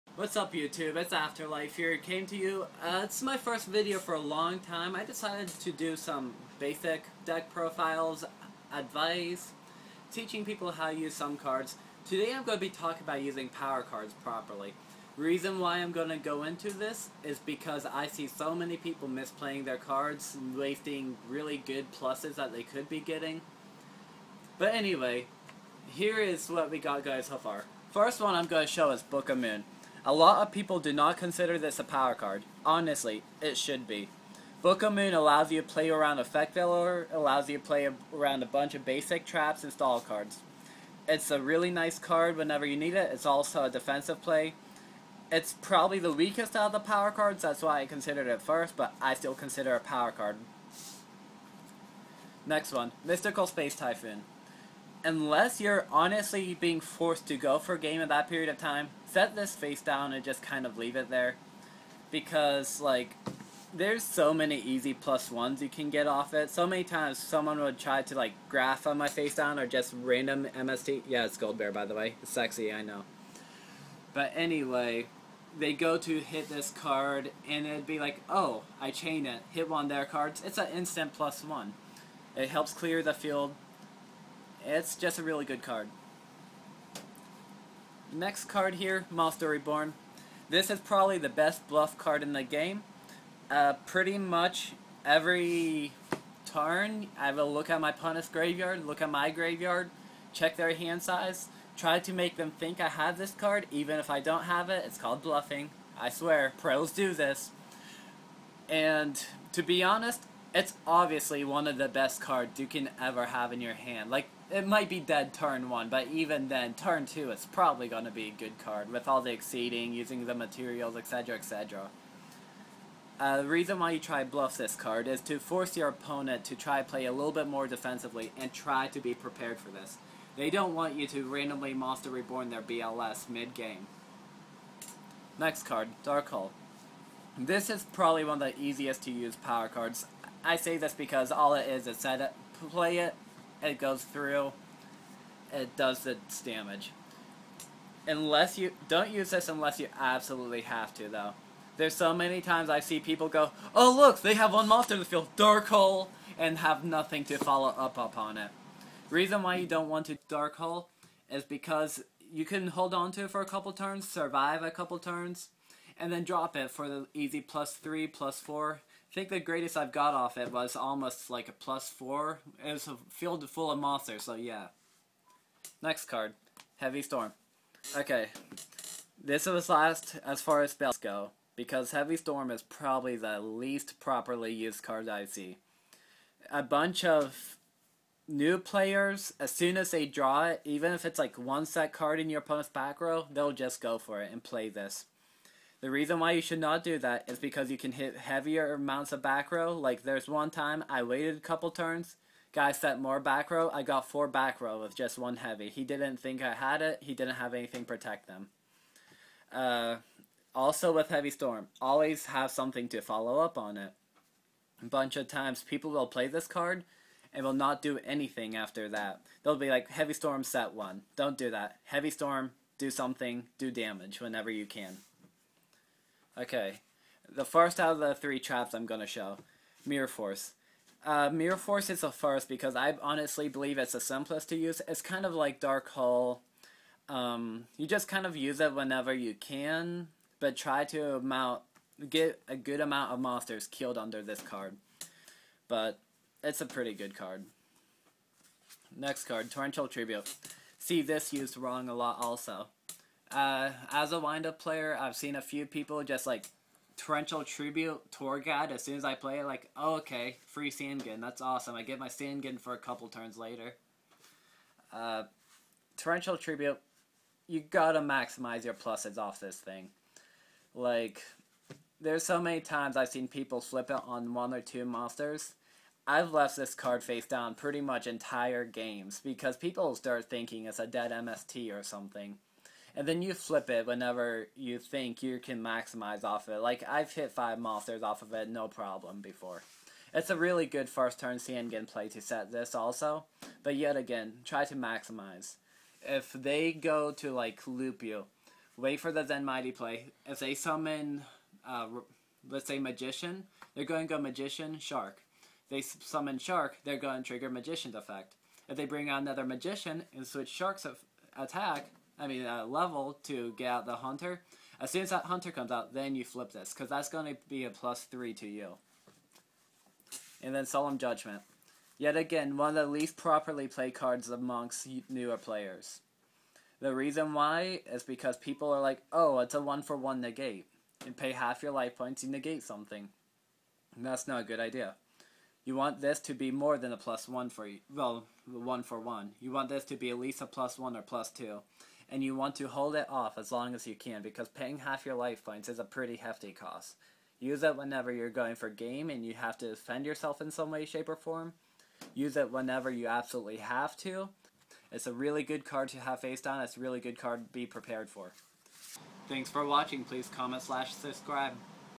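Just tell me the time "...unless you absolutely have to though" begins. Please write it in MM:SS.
02:29.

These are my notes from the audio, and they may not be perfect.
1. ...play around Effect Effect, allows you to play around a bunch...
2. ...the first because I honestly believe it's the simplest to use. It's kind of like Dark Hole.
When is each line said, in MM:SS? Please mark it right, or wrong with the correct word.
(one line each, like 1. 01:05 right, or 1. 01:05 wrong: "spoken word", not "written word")
1. 00:35 wrong: "Veiler", not "Effect"
2. 03:52 right.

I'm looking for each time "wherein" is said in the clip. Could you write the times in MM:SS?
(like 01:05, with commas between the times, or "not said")
not said.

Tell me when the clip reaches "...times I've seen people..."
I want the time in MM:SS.
04:32.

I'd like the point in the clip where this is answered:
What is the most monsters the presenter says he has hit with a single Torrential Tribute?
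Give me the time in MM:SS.
04:47.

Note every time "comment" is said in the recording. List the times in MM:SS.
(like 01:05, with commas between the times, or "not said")
06:00.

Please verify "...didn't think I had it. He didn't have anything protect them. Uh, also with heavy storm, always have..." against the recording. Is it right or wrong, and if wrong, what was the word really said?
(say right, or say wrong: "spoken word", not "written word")
right.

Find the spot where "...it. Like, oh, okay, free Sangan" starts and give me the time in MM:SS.
04:19.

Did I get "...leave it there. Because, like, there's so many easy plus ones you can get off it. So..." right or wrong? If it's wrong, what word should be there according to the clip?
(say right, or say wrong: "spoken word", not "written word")
right.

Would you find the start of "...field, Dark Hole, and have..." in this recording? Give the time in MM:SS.
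02:35.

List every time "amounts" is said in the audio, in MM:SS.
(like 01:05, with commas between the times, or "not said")
03:18, 04:02.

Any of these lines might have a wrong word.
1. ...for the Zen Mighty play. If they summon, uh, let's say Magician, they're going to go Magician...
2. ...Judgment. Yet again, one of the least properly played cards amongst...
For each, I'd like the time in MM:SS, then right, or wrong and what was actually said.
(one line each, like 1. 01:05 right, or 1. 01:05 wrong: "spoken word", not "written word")
1. 04:58 right
2. 05:20 right.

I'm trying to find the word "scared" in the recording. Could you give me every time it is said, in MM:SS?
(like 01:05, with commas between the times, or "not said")
not said.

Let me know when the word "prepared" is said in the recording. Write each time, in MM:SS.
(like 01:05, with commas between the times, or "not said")
02:09, 05:57.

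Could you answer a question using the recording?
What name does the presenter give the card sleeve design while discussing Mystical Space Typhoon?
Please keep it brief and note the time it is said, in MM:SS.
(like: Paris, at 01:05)
Gold Bear, at 01:11.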